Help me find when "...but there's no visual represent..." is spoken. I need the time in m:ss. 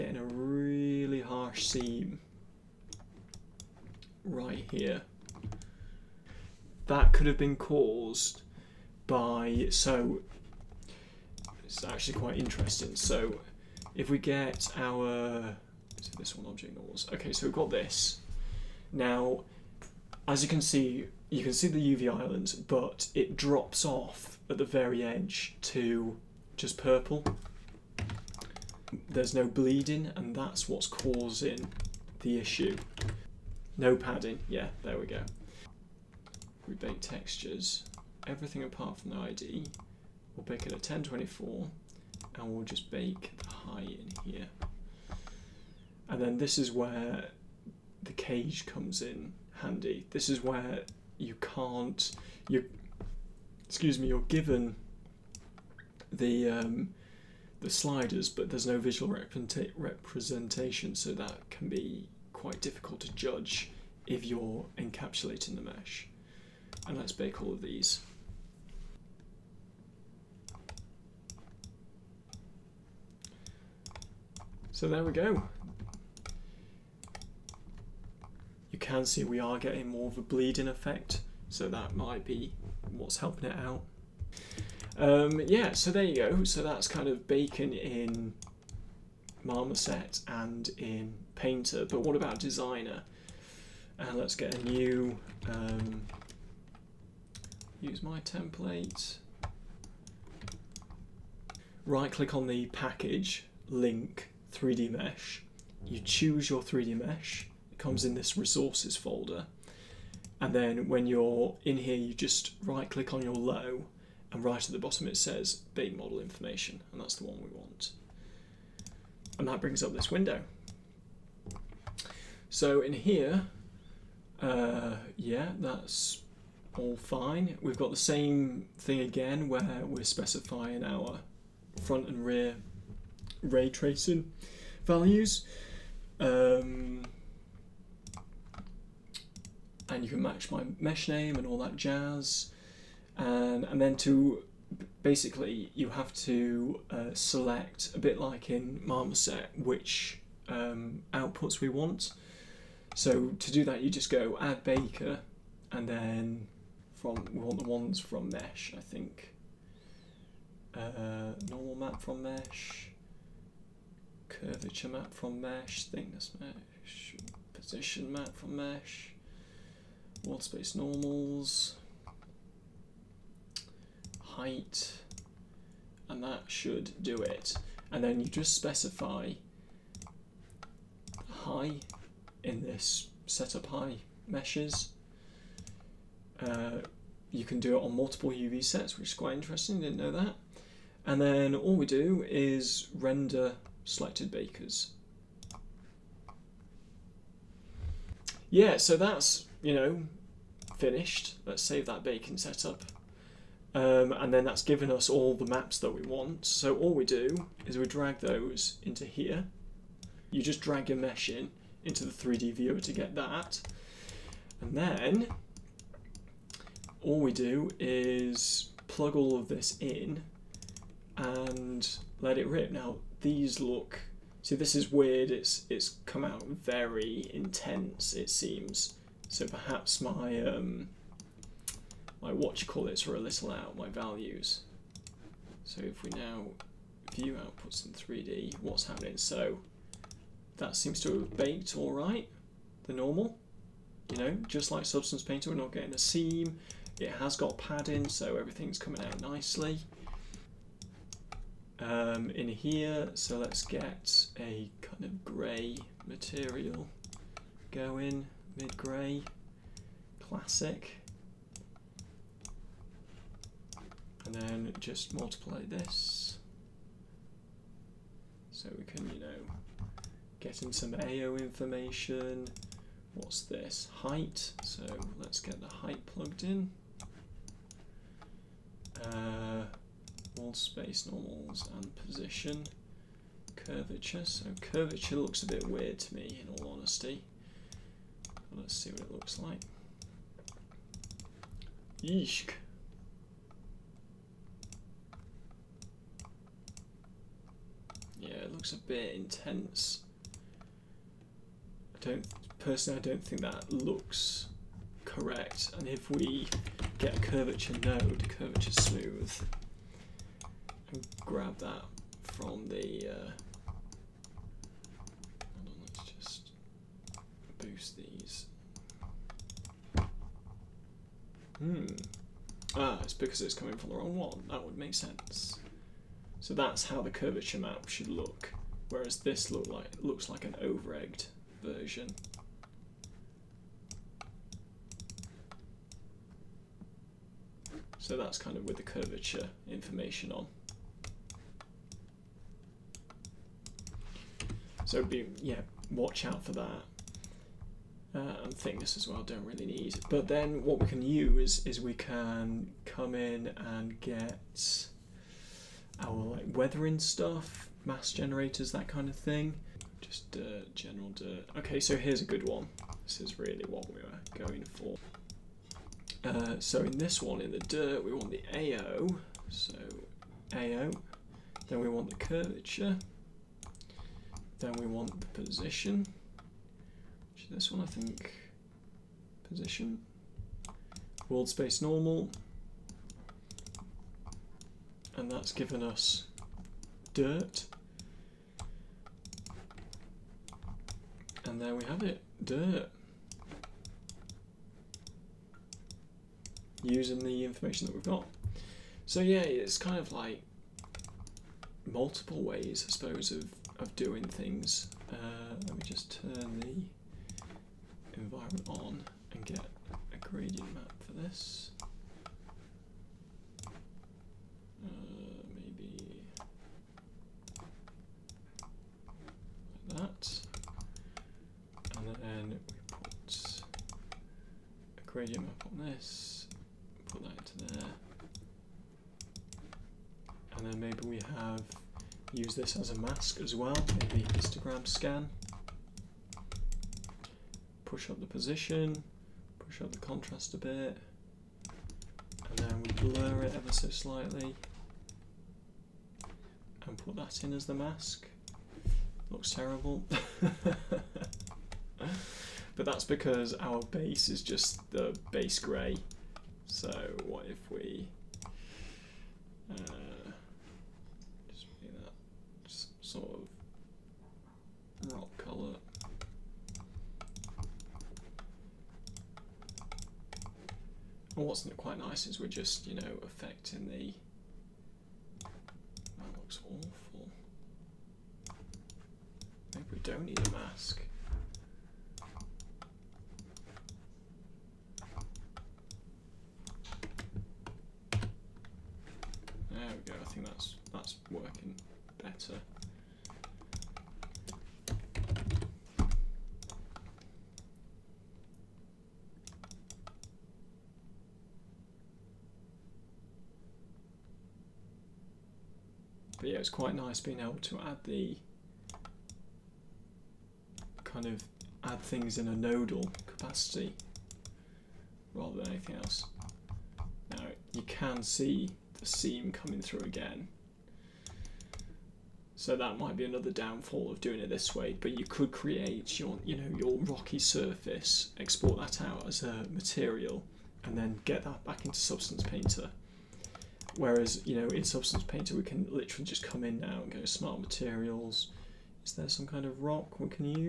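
0:58.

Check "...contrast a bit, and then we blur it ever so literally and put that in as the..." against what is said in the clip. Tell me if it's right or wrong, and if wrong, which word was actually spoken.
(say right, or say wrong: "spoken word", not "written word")
wrong: "slightly", not "literally".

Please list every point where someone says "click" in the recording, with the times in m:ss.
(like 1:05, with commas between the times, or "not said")
1:42, 1:52.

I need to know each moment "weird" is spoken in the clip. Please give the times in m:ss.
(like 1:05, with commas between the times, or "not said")
3:44, 4:45.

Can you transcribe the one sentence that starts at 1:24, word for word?
Um, yeah, so there you go.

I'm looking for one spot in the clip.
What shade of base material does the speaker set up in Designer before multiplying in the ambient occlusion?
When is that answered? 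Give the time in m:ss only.
4:18.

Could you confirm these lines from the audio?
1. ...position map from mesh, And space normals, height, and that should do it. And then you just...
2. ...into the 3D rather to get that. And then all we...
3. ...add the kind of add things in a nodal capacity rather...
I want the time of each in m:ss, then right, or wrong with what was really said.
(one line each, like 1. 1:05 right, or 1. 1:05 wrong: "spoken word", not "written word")
1. 2:47 wrong: "World", not "And"
2. 3:31 wrong: "viewer", not "rather"
3. 8:27 right.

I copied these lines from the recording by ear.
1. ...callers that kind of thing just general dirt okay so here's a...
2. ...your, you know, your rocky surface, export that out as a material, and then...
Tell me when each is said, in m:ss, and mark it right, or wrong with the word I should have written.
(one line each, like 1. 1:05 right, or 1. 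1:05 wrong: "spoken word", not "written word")
1. 5:58 wrong: "generators", not "callers"
2. 8:46 right.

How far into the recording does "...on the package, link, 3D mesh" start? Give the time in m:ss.
1:42.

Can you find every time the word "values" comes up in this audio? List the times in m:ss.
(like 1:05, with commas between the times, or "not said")
2:14, 3:53.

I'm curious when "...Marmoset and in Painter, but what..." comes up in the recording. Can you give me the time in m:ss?
1:29.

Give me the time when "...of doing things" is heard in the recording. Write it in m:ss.
6:43.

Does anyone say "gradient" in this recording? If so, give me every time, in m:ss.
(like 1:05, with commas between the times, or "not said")
6:50, 7:05.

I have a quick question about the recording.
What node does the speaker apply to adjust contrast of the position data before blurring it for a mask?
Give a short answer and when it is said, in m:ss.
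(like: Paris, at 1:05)
histogram scan, at 7:14.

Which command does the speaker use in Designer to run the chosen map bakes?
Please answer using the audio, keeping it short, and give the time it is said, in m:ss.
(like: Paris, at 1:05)
render selected bakers, at 3:12.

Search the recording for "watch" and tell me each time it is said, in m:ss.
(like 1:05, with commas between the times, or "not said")
3:52, 5:45.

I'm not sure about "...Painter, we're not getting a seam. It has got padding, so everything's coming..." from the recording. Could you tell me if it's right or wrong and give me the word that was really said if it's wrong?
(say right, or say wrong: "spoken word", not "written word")
right.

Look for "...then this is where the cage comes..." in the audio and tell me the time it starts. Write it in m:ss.
0:46.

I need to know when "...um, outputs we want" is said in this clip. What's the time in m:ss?
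2:30.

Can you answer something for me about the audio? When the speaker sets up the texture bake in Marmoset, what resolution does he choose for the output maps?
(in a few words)
1024.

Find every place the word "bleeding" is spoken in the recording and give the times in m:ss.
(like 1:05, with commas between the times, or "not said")
0:29, 1:20.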